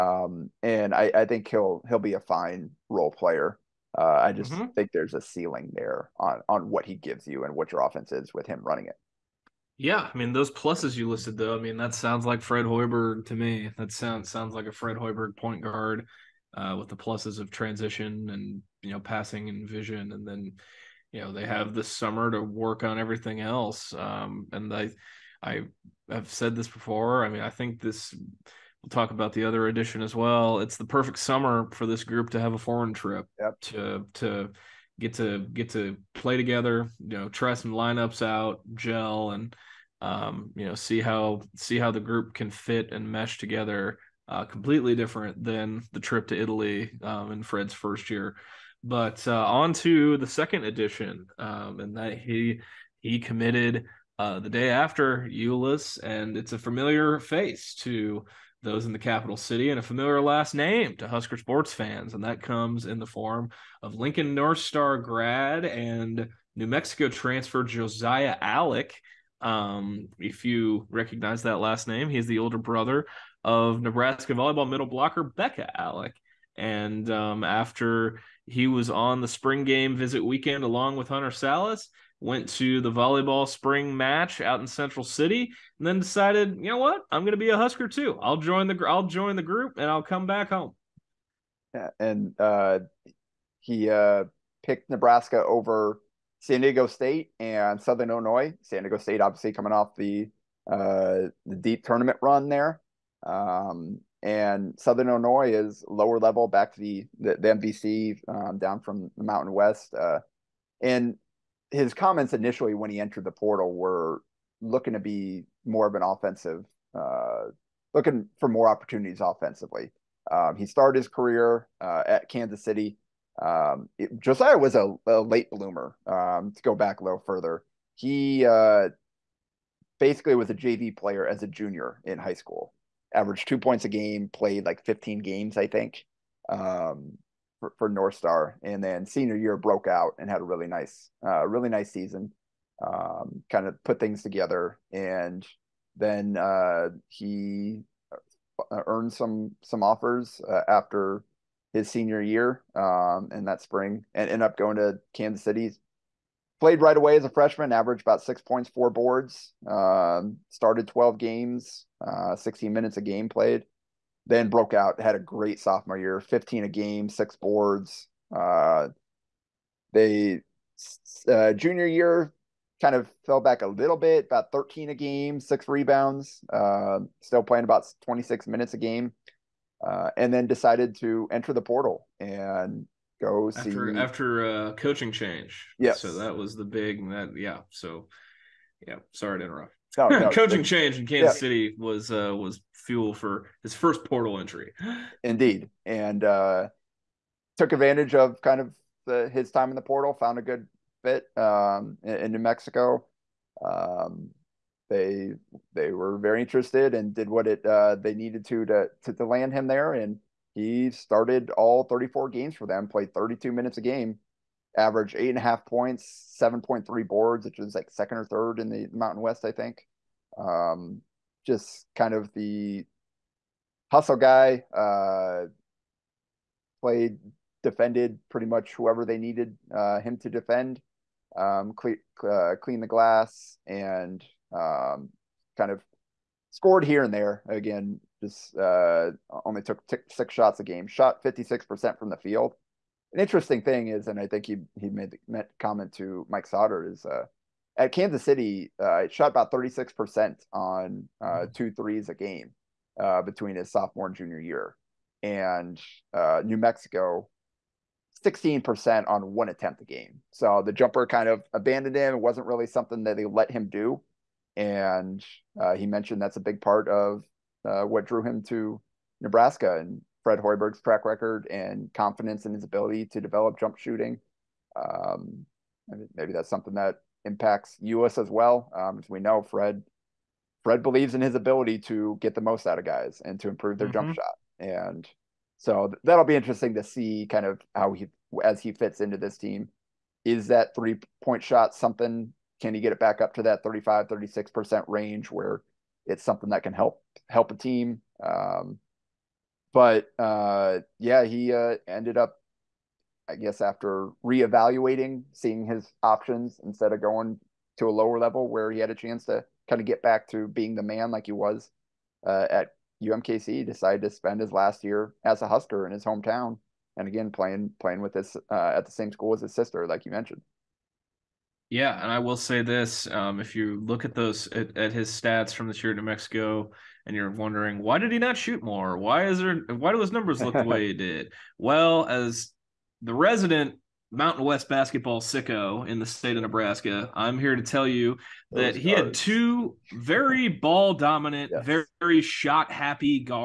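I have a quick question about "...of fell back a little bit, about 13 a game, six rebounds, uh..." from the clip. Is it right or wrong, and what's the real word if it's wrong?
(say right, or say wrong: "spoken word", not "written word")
right.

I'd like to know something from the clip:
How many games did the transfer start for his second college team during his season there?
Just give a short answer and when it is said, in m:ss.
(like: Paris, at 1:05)
34, at 3:31.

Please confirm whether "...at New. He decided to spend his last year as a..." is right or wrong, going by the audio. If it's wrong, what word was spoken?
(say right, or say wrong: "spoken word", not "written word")
wrong: "UMKC", not "New".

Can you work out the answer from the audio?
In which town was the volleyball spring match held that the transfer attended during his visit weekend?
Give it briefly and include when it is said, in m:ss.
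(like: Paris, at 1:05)
Central City, at 1:24.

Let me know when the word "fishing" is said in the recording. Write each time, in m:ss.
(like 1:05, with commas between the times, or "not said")
not said.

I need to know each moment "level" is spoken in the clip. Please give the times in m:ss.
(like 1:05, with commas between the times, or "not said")
1:46, 5:08.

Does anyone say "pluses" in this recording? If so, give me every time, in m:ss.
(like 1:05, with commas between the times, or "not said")
0:10, 0:16.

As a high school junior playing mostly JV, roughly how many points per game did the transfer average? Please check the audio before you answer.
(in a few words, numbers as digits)
2.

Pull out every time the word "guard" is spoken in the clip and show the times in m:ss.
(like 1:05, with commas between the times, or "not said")
0:15, 5:38.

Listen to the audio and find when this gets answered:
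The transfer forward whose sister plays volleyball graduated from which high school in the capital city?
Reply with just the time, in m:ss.
1:03.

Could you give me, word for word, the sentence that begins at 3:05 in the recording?
Yeah, so that was the big that yeah.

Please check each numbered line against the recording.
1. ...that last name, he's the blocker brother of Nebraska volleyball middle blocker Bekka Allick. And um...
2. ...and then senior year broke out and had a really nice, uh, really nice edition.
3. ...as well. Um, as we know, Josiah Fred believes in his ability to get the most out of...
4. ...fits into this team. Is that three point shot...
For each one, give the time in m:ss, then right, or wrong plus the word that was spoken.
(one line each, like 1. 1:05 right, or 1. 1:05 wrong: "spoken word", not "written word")
1. 1:11 wrong: "older", not "blocker"
2. 2:18 wrong: "season", not "edition"
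3. 4:38 wrong: "Fred", not "Josiah"
4. 4:48 right.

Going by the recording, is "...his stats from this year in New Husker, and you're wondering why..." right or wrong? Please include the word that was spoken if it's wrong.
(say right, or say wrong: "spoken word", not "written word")
wrong: "Mexico", not "Husker".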